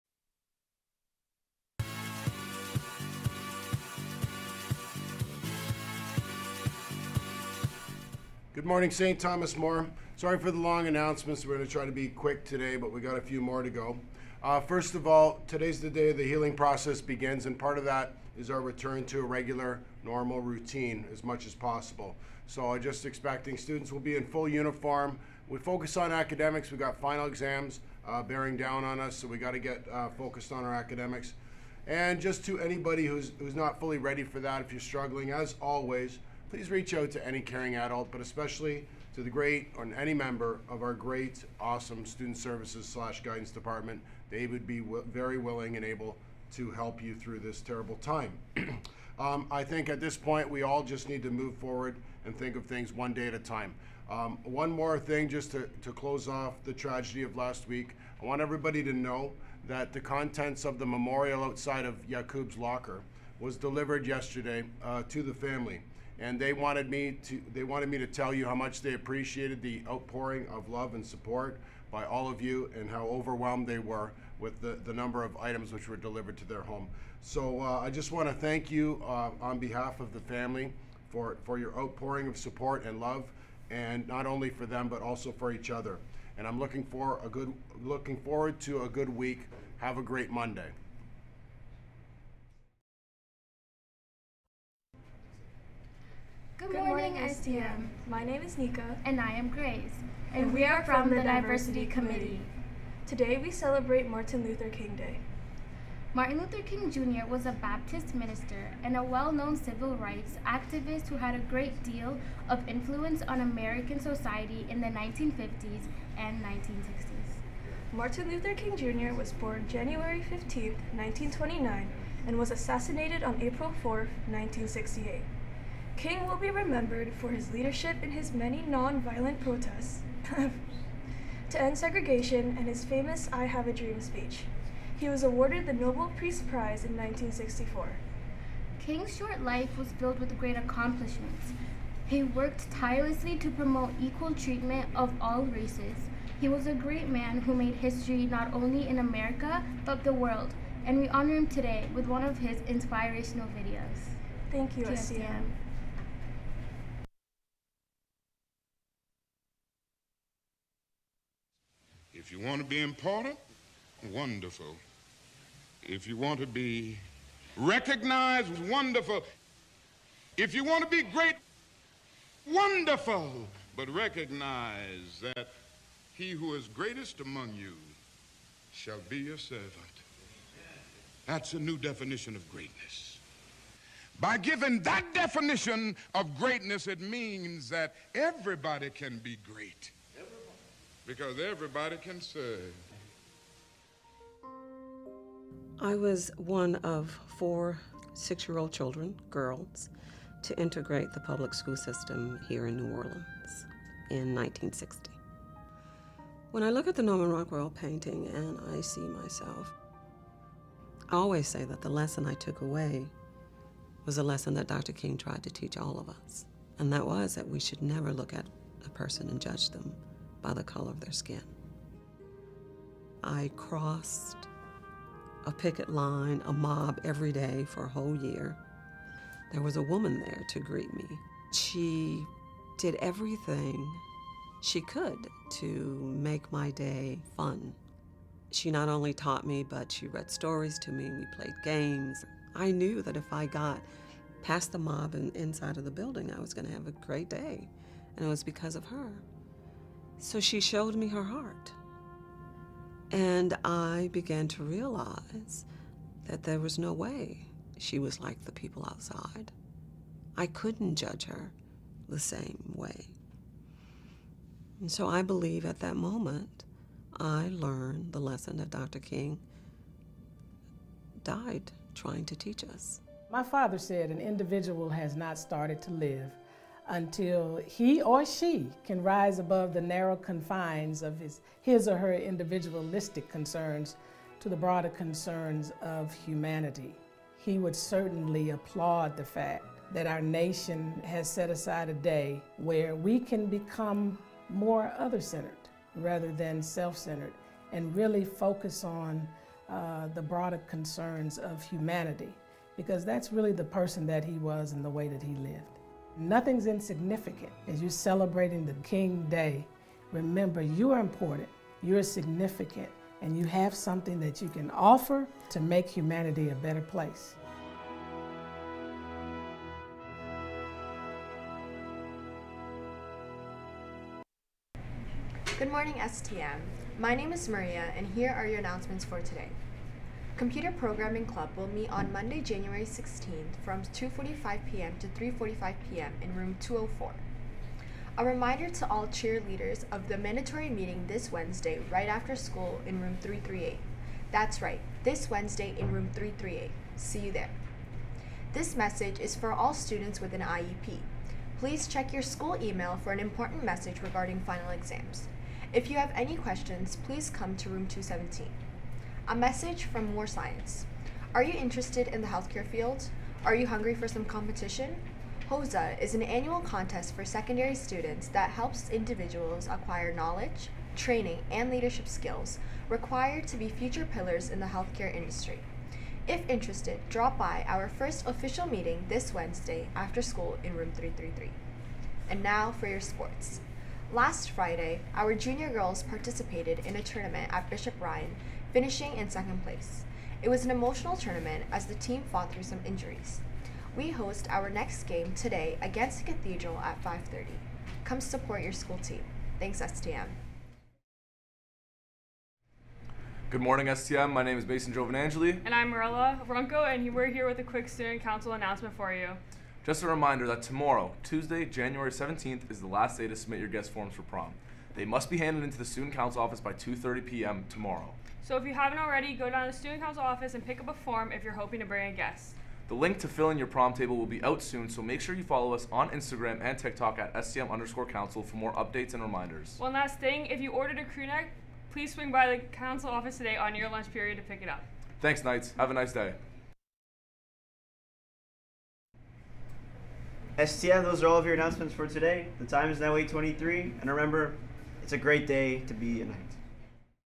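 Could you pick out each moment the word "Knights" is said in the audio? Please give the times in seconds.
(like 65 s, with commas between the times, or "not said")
435 s, 446 s.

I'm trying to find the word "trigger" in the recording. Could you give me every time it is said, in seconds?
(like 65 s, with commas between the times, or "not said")
not said.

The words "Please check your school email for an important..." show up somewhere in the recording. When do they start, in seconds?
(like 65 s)
351 s.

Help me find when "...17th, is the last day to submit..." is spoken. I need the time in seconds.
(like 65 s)
412 s.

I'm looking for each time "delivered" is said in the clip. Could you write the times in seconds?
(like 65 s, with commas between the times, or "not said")
63 s, 75 s.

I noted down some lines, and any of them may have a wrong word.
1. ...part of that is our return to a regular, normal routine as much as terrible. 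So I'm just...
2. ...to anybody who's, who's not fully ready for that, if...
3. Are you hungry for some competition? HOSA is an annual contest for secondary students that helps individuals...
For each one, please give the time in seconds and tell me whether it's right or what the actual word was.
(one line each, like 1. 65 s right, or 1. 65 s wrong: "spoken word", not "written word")
1. 17 s wrong: "possible", not "terrible"
2. 32 s right
3. 363 s right.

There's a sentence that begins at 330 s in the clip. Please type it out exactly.
Computer Programming Club will meet on Monday, January 16th from 2.45 p.m.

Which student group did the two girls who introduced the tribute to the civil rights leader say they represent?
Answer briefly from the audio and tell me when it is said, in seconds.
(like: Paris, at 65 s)
Diversity Committee, at 101 s.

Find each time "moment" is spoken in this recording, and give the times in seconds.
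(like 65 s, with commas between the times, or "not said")
265 s.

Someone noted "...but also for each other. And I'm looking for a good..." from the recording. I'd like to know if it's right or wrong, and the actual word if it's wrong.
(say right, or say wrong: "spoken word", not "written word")
right.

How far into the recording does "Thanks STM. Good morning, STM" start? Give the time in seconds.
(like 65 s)
399 s.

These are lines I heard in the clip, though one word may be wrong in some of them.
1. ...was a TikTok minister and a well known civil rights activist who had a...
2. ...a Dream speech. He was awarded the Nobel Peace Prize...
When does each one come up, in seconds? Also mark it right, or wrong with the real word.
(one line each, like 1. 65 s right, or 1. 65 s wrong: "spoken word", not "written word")
1. 107 s wrong: "Baptist", not "TikTok"
2. 133 s right.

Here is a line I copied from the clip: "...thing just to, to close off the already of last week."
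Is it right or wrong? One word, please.
wrong.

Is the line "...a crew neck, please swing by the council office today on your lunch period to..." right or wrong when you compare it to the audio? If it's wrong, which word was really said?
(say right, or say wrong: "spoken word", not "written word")
right.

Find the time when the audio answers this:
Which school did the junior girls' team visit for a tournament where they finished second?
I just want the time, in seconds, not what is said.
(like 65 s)
387 s.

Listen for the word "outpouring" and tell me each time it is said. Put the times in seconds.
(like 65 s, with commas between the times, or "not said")
69 s, 81 s.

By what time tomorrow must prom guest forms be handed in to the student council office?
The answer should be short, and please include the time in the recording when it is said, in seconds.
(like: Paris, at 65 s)
2:30 p.m., at 416 s.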